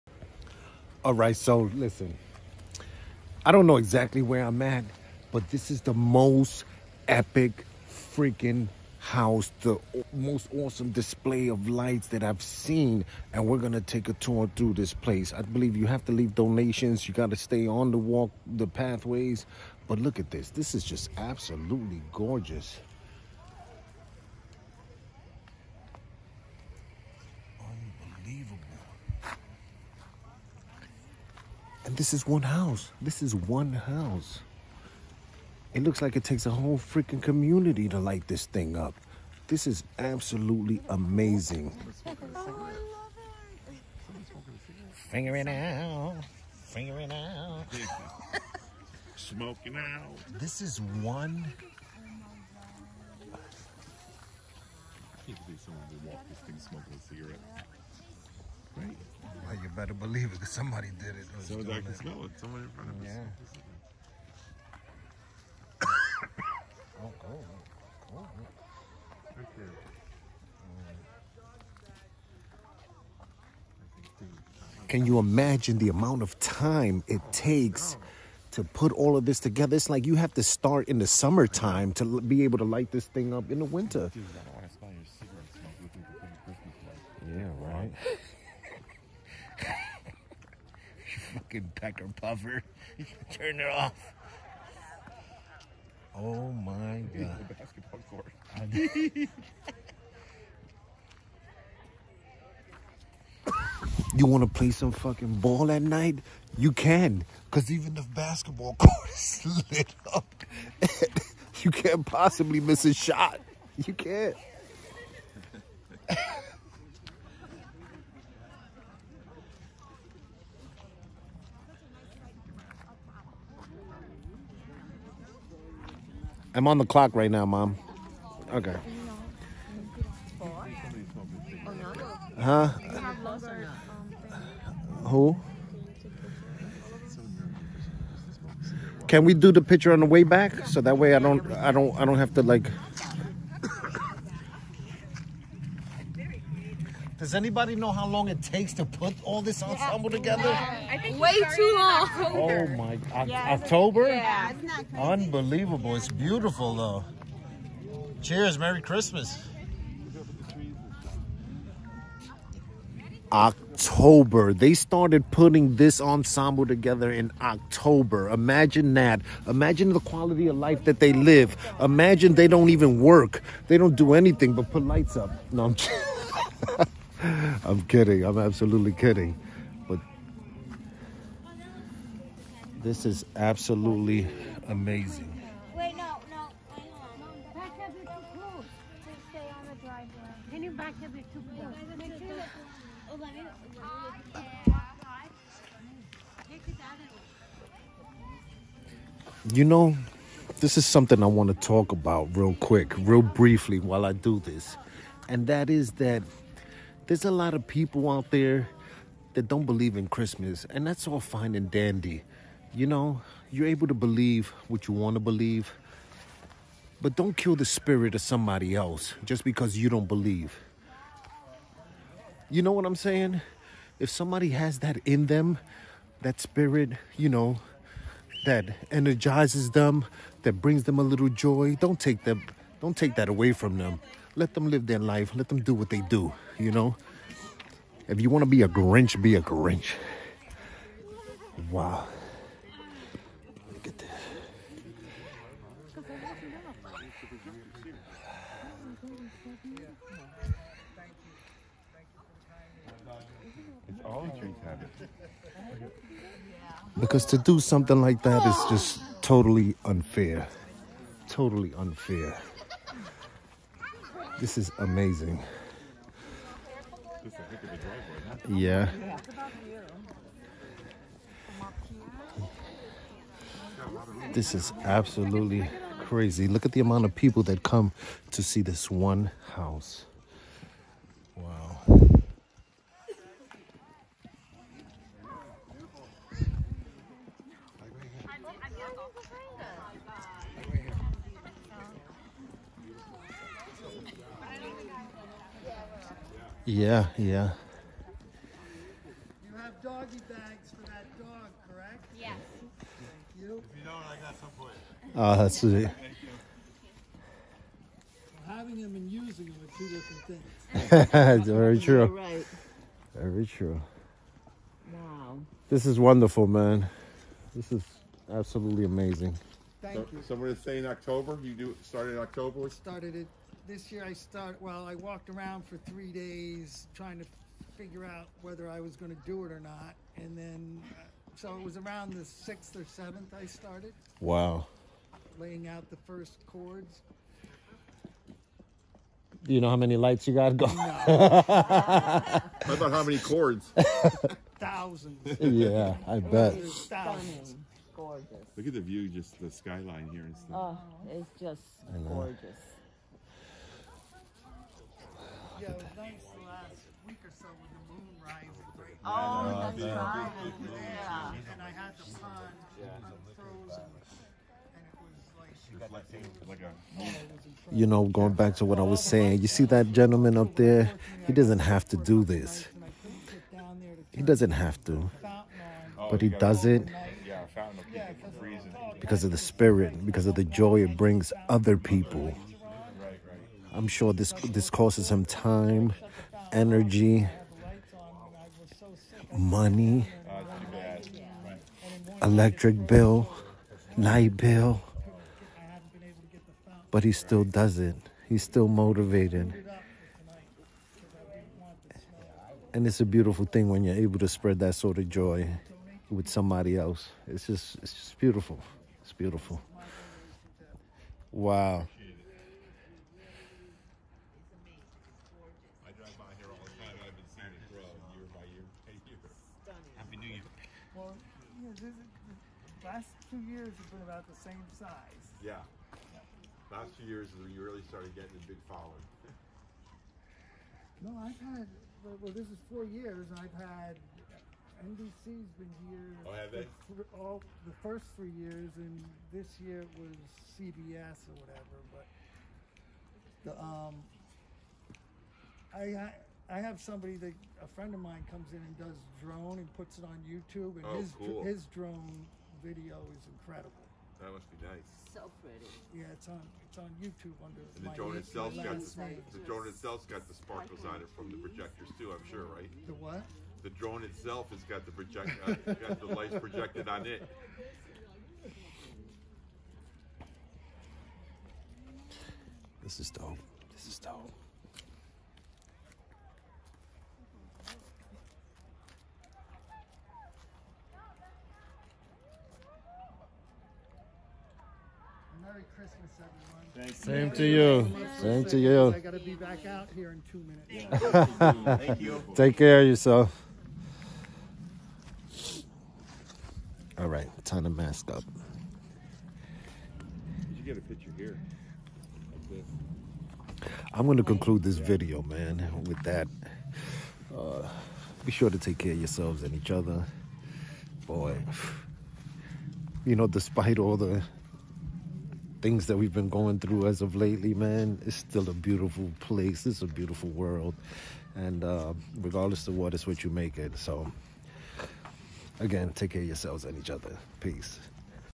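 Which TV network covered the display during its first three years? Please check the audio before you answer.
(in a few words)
NBC.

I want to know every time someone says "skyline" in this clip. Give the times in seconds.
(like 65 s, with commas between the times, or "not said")
349 s.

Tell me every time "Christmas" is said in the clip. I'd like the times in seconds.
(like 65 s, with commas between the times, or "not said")
158 s, 210 s, 485 s.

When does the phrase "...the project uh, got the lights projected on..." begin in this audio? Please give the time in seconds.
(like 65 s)
464 s.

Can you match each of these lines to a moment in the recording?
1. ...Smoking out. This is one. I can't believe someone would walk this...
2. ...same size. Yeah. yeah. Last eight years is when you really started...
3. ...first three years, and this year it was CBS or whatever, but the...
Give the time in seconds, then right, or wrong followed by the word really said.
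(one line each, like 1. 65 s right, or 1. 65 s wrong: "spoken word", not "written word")
1. 49 s right
2. 424 s wrong: "two", not "eight"
3. 437 s right.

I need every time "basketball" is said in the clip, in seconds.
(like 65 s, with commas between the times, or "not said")
97 s, 108 s.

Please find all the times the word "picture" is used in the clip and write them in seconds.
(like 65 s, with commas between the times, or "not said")
139 s, 500 s.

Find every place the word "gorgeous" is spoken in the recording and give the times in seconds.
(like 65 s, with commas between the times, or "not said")
22 s, 347 s, 352 s.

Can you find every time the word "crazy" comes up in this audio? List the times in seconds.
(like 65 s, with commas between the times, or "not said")
154 s, 275 s.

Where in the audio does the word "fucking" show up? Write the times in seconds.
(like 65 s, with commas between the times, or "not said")
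91 s, 104 s.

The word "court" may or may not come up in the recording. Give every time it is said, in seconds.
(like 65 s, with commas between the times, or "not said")
98 s, 108 s.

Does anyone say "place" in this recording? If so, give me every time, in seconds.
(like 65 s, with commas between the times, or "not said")
14 s, 519 s.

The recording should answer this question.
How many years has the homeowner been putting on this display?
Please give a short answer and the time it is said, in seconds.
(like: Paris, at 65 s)
4, at 432 s.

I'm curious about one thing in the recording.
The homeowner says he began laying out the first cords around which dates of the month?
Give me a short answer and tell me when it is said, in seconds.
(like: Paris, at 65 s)
6th or 7th, at 332 s.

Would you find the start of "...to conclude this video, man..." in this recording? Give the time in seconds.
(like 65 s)
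504 s.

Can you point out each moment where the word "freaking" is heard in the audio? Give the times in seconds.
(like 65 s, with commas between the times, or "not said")
7 s, 36 s.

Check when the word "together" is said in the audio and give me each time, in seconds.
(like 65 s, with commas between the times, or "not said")
79 s, 150 s, 166 s.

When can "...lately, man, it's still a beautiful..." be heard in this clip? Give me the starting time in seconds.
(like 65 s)
517 s.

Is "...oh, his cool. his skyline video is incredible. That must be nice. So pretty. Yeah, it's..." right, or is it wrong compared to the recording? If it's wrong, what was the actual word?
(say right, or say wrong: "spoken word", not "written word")
wrong: "drone", not "skyline".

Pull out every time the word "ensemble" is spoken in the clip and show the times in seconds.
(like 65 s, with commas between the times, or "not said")
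149 s, 166 s.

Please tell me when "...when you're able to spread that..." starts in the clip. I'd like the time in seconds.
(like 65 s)
403 s.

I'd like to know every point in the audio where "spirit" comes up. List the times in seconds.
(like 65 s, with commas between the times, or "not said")
217 s, 226 s, 379 s.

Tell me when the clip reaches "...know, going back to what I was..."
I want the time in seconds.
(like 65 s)
367 s.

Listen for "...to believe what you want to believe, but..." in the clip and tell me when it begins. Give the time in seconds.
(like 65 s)
213 s.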